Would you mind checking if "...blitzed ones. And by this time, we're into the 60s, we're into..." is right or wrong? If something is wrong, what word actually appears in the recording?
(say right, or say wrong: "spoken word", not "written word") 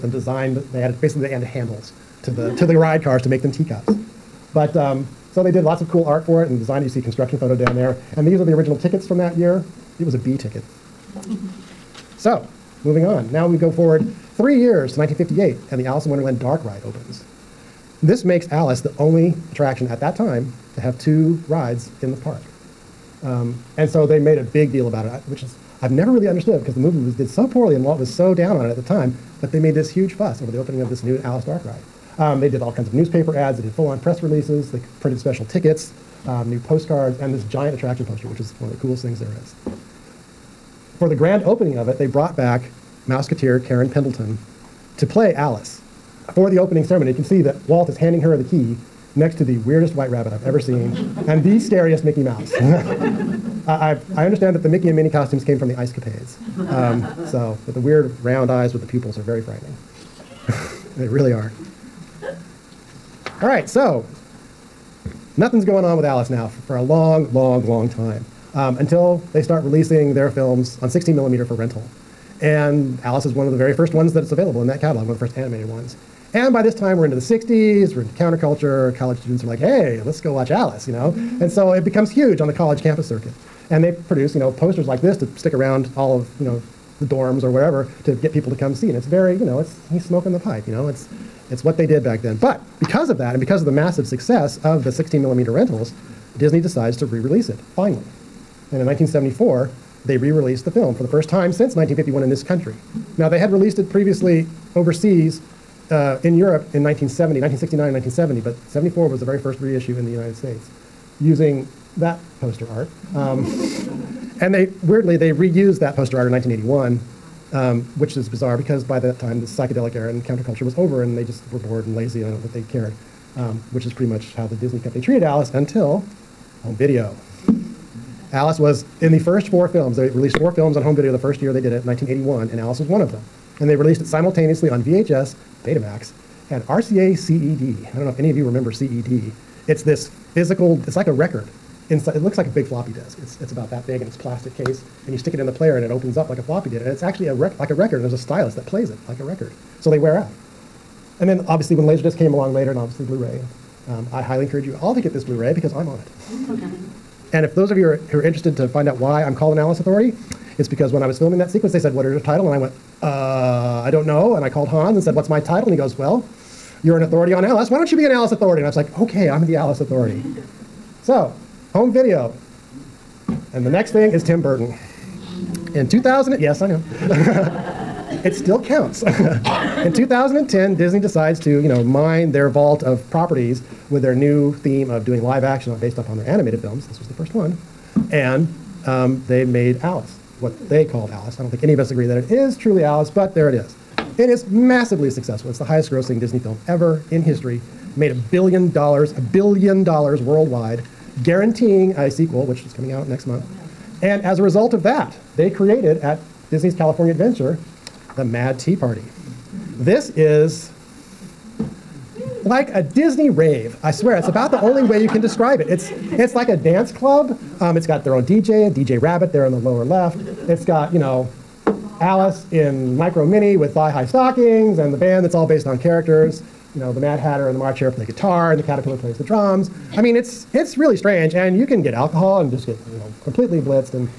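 wrong: "animated", not "blitzed".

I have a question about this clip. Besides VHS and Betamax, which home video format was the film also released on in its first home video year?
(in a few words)
RCA CED.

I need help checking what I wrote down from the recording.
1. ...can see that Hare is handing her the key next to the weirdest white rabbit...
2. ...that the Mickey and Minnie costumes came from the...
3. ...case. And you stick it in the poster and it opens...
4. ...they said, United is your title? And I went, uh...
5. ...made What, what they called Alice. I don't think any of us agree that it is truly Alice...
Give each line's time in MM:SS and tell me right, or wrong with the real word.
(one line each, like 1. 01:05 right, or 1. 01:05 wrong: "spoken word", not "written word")
1. 00:47 wrong: "Walt", not "Hare"
2. 00:54 right
3. 02:24 wrong: "player", not "poster"
4. 02:41 wrong: "What", not "United"
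5. 03:09 wrong: "Alice", not "What".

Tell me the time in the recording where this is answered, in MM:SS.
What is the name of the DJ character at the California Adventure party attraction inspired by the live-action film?
03:38.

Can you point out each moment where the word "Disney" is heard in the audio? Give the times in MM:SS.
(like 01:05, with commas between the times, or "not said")
01:36, 02:04, 03:00, 03:16, 03:26, 03:32.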